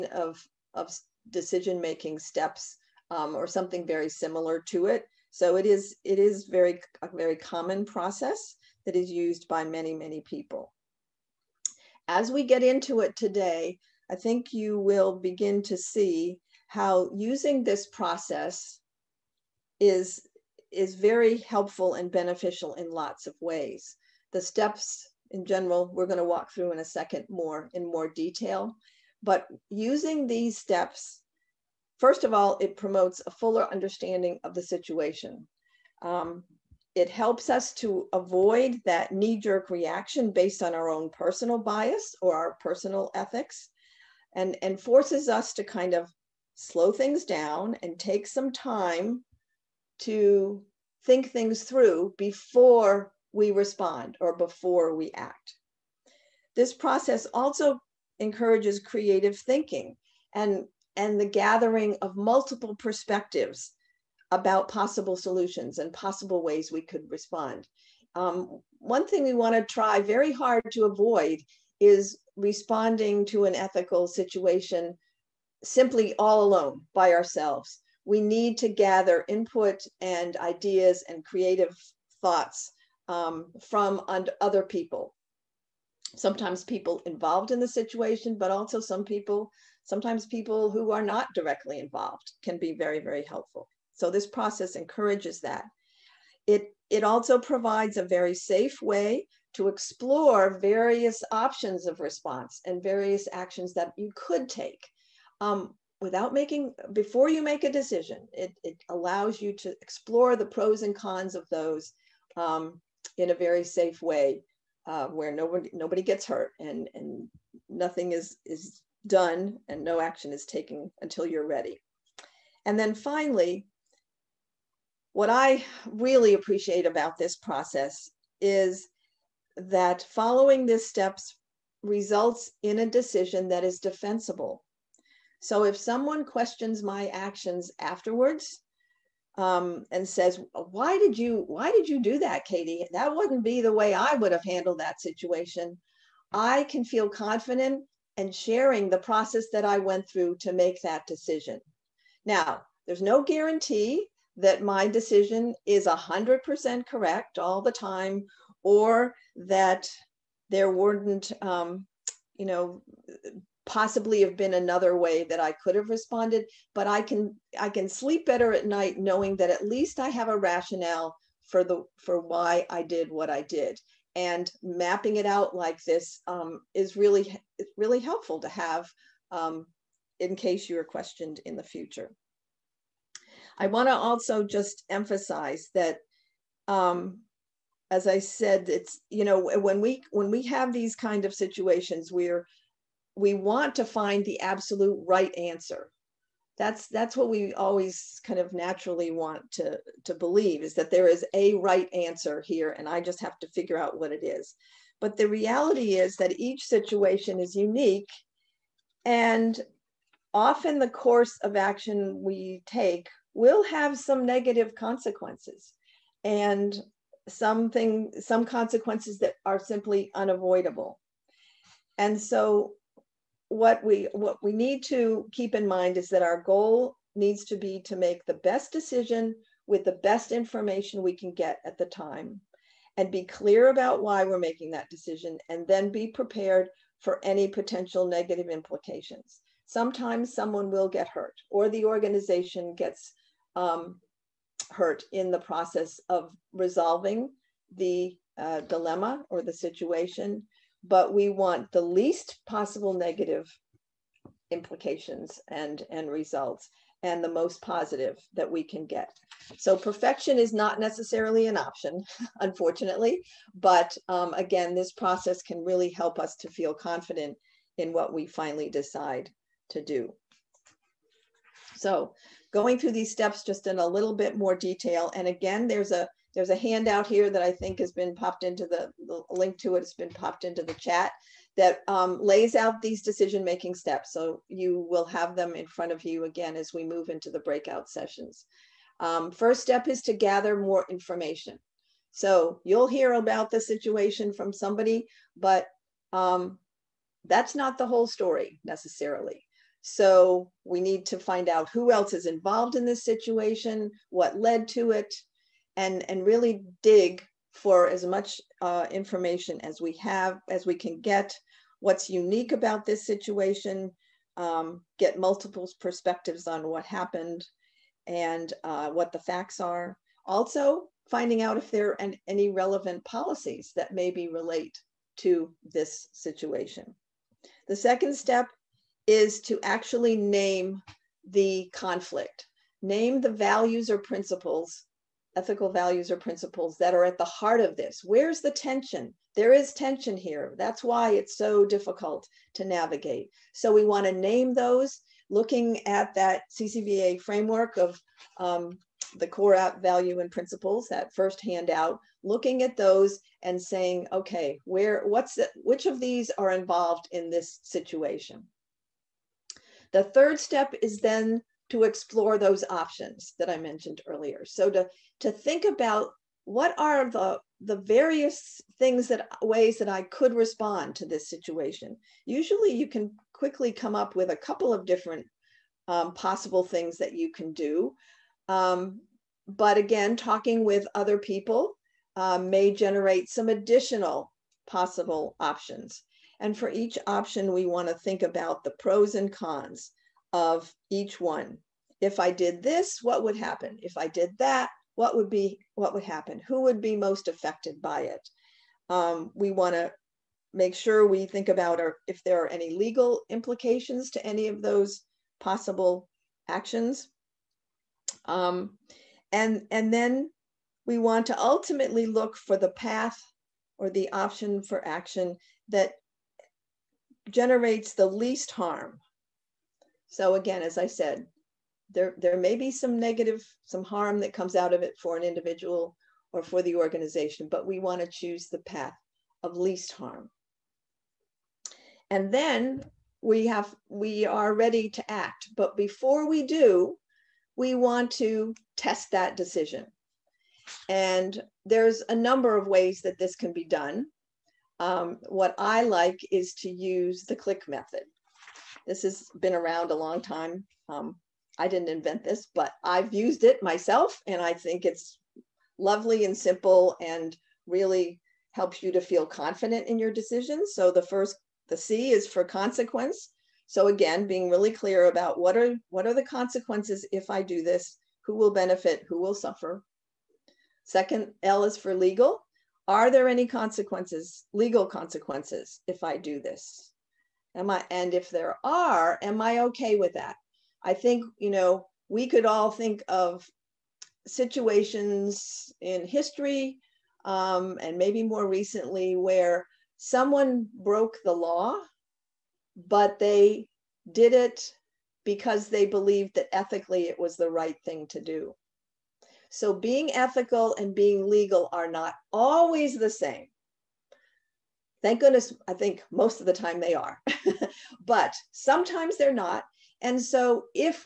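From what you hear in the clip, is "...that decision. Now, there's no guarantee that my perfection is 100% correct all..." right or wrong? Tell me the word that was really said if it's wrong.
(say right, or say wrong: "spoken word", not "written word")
wrong: "decision", not "perfection".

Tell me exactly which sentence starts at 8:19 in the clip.
So being ethical and being legal are not always the same.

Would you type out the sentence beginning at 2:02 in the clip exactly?
And then finally, what I really appreciate about this process is that following these steps results in a decision that is defensible.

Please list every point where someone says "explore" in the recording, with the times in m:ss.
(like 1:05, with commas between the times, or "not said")
1:39, 1:49, 6:01.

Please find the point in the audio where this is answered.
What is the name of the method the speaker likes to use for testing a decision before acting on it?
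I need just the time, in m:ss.
7:27.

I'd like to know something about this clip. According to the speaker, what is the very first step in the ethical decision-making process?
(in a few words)
gather more information.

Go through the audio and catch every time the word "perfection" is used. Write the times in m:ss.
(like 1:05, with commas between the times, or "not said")
4:19.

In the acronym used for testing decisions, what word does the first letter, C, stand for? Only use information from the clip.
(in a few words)
consequence.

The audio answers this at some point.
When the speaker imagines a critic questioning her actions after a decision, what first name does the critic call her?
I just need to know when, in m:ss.
2:22.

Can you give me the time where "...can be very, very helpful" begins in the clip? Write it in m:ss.
1:32.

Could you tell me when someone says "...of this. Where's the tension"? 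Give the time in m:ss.
5:37.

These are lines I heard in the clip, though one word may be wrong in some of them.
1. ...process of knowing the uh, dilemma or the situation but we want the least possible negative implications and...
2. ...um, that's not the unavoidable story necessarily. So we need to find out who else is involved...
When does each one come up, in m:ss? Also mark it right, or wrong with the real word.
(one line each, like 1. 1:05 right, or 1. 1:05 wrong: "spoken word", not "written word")
1. 4:05 wrong: "resolving", not "knowing"
2. 4:56 wrong: "whole", not "unavoidable".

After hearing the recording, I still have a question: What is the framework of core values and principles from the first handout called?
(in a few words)
CCVA.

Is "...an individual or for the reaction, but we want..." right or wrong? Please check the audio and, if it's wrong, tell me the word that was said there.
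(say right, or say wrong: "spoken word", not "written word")
wrong: "organization", not "reaction".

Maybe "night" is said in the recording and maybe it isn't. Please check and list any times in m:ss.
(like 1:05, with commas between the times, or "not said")
2:48.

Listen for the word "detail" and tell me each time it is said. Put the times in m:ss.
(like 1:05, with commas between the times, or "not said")
0:28, 4:34.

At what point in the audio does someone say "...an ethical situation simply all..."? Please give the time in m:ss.
1:13.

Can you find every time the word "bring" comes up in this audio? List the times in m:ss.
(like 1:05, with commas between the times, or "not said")
not said.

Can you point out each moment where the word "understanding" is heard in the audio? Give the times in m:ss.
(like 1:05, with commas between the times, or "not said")
0:33.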